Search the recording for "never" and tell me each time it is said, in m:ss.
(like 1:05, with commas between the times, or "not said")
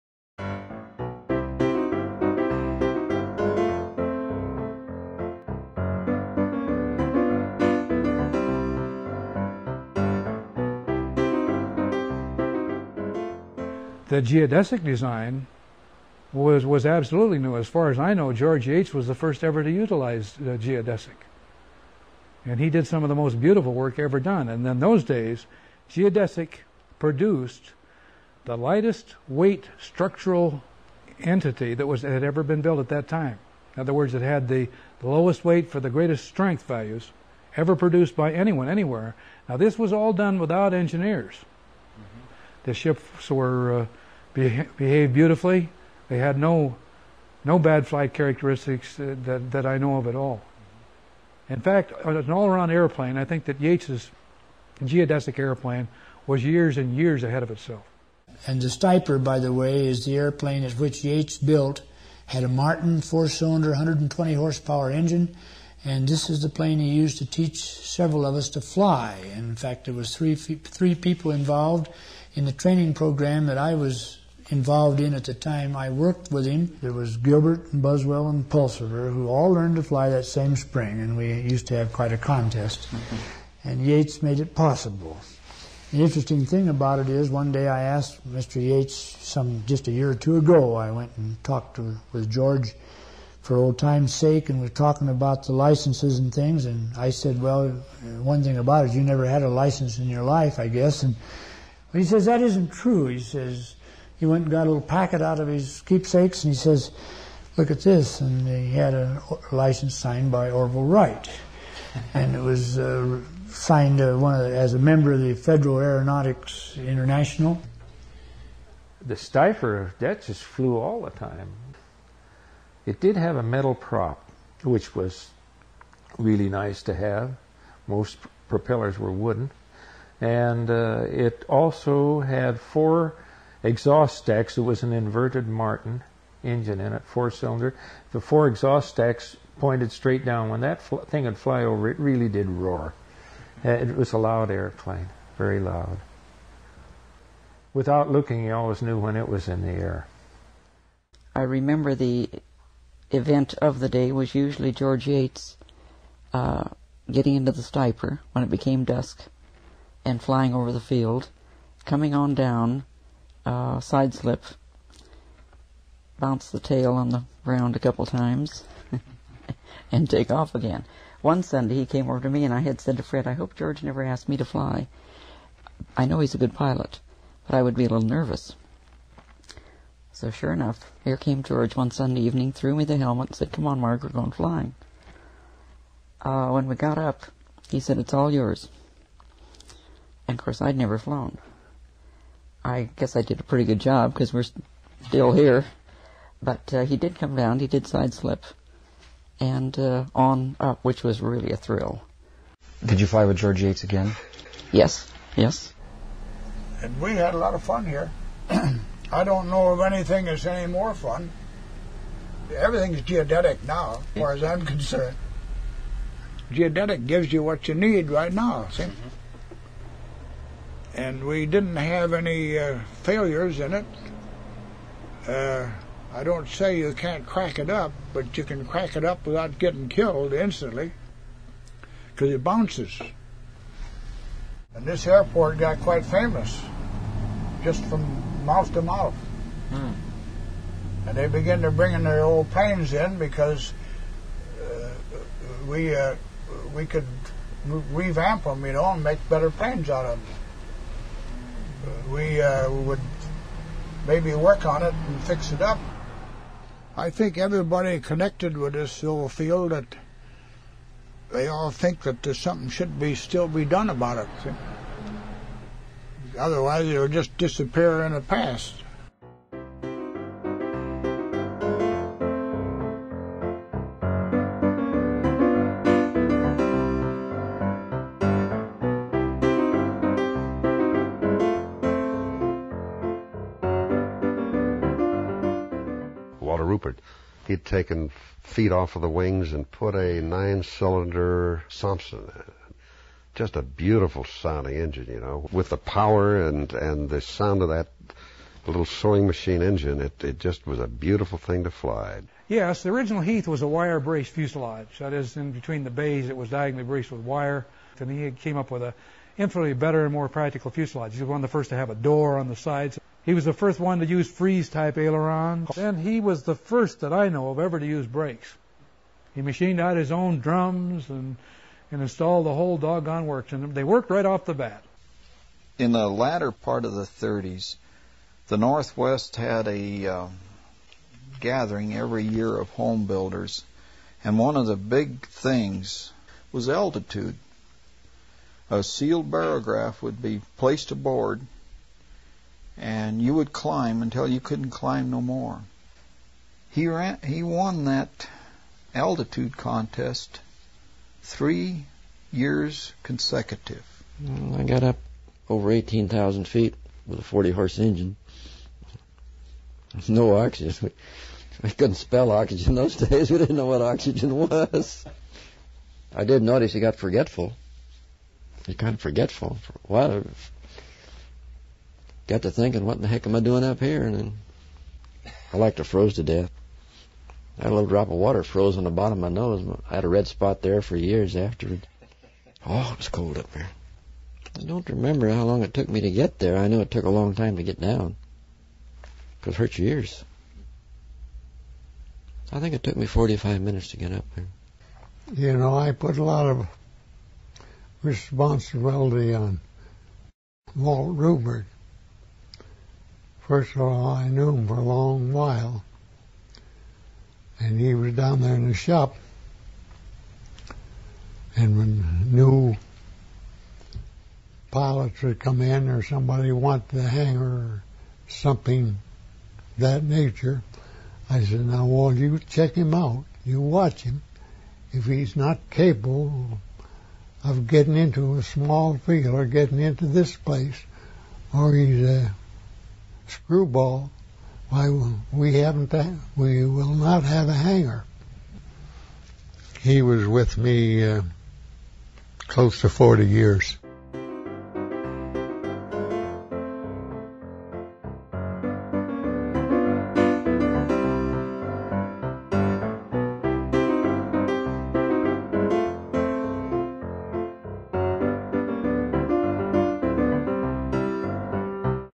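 1:39, 2:53, 3:10.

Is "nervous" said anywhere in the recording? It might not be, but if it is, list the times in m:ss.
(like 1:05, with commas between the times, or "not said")
2:58.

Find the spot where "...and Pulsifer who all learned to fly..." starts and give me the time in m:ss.
1:18.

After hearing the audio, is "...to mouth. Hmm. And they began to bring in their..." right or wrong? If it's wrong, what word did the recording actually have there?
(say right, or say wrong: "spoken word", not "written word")
right.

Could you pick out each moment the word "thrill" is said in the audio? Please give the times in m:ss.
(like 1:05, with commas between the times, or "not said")
3:21.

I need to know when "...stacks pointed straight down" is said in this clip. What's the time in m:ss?
2:18.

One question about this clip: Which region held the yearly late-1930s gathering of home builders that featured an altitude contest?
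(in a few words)
the Northwest.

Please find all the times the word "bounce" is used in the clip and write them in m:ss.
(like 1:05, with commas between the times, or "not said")
2:46, 3:52.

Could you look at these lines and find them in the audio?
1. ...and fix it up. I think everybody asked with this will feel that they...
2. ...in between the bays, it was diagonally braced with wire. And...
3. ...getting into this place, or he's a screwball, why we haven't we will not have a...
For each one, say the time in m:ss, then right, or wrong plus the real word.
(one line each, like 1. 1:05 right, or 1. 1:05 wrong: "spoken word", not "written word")
1. 4:14 wrong: "connected", not "asked"
2. 5:05 right
3. 7:09 right.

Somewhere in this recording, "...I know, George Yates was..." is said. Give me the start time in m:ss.
0:17.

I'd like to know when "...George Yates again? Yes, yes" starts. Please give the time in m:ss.
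3:23.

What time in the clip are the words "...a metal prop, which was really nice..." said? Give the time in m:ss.
2:03.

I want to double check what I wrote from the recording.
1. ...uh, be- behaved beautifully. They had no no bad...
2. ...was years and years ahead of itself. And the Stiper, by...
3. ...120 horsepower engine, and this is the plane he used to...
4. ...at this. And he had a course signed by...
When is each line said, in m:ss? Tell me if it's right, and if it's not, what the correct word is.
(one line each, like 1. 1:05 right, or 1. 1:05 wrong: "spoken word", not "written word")
1. 0:43 right
2. 0:56 right
3. 1:03 right
4. 1:47 wrong: "license", not "course".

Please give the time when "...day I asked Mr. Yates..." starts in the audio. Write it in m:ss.
1:27.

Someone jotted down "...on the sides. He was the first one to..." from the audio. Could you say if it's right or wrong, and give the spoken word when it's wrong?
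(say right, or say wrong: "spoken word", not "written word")
right.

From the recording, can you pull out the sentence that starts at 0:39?
Now, this was all done without engineers.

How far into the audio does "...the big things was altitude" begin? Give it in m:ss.
5:34.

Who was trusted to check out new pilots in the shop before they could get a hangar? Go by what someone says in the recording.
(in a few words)
Walt Rubert.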